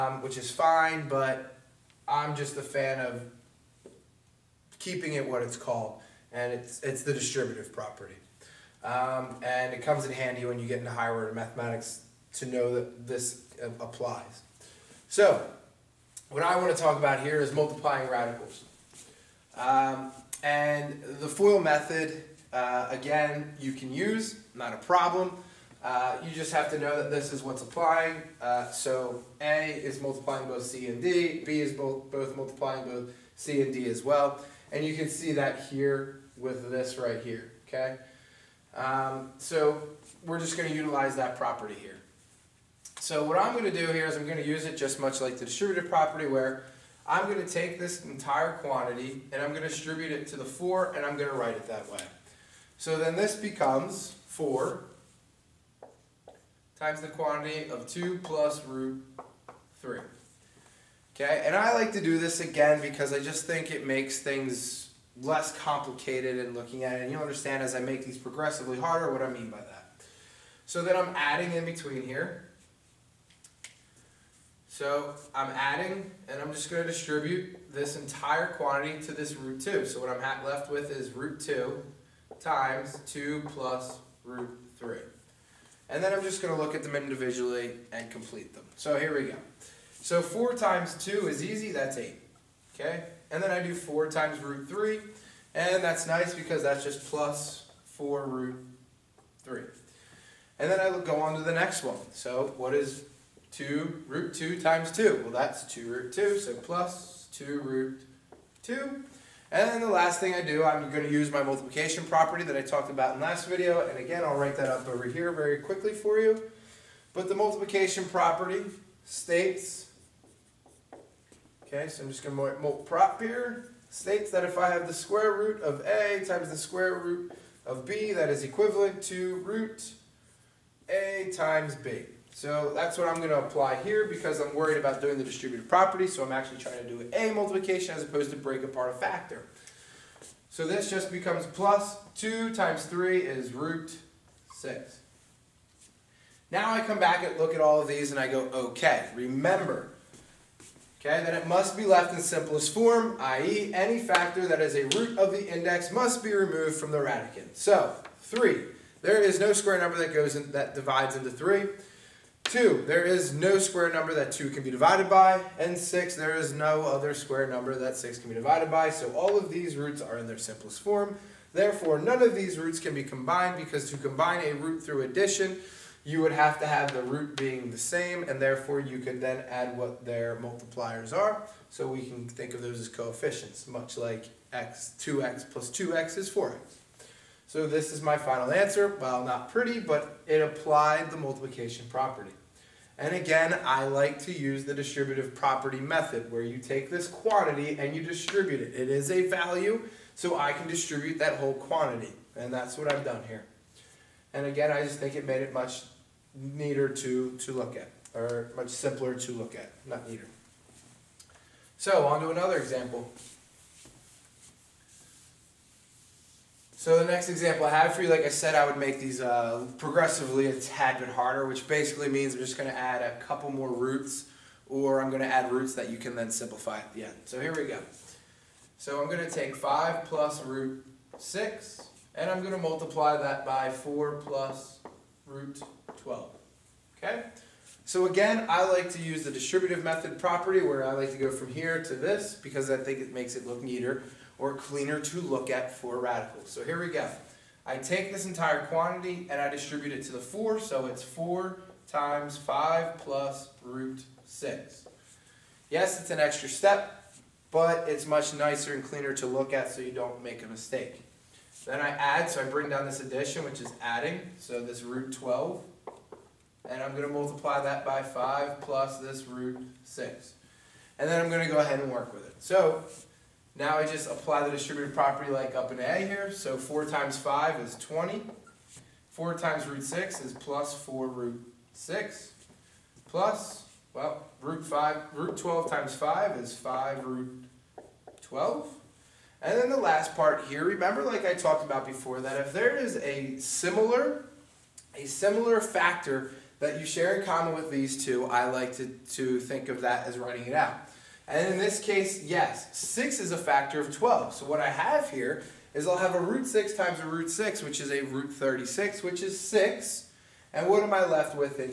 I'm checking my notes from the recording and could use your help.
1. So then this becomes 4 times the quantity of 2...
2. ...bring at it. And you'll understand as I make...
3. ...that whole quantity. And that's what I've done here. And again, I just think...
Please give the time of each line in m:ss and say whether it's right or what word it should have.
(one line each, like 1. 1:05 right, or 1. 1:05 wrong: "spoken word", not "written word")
1. 0:52 right
2. 1:06 wrong: "looking", not "bring"
3. 3:21 right.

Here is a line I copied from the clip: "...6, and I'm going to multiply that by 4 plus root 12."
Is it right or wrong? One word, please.
right.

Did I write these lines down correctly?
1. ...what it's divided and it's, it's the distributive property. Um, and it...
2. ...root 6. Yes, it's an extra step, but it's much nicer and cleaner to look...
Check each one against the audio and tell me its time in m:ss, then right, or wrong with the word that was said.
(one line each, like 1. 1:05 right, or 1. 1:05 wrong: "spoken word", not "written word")
1. 0:05 wrong: "called", not "divided"
2. 4:13 right.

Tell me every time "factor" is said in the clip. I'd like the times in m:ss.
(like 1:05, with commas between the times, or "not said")
2:18, 2:33, 4:55, 5:03.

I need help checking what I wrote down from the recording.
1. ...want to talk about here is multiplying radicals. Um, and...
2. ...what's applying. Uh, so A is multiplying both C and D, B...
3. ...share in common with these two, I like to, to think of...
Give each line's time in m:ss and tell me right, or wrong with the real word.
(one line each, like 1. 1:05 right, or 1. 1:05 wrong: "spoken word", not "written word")
1. 0:16 right
2. 0:27 right
3. 4:56 right.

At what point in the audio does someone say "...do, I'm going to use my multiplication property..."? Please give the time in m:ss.
1:50.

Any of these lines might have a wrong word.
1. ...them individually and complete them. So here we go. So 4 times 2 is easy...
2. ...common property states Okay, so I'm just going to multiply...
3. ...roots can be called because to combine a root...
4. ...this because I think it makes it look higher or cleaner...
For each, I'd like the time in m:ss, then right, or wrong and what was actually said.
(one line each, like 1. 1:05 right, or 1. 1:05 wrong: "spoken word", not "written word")
1. 1:26 right
2. 1:57 wrong: "multiplication", not "common"
3. 2:52 wrong: "combined", not "called"
4. 4:01 wrong: "neater", not "higher".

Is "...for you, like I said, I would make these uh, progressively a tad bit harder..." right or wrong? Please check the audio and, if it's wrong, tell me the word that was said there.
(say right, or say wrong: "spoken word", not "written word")
right.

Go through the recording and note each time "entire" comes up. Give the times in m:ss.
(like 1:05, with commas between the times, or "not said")
0:48, 1:17, 4:08.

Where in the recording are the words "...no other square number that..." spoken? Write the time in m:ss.
2:46.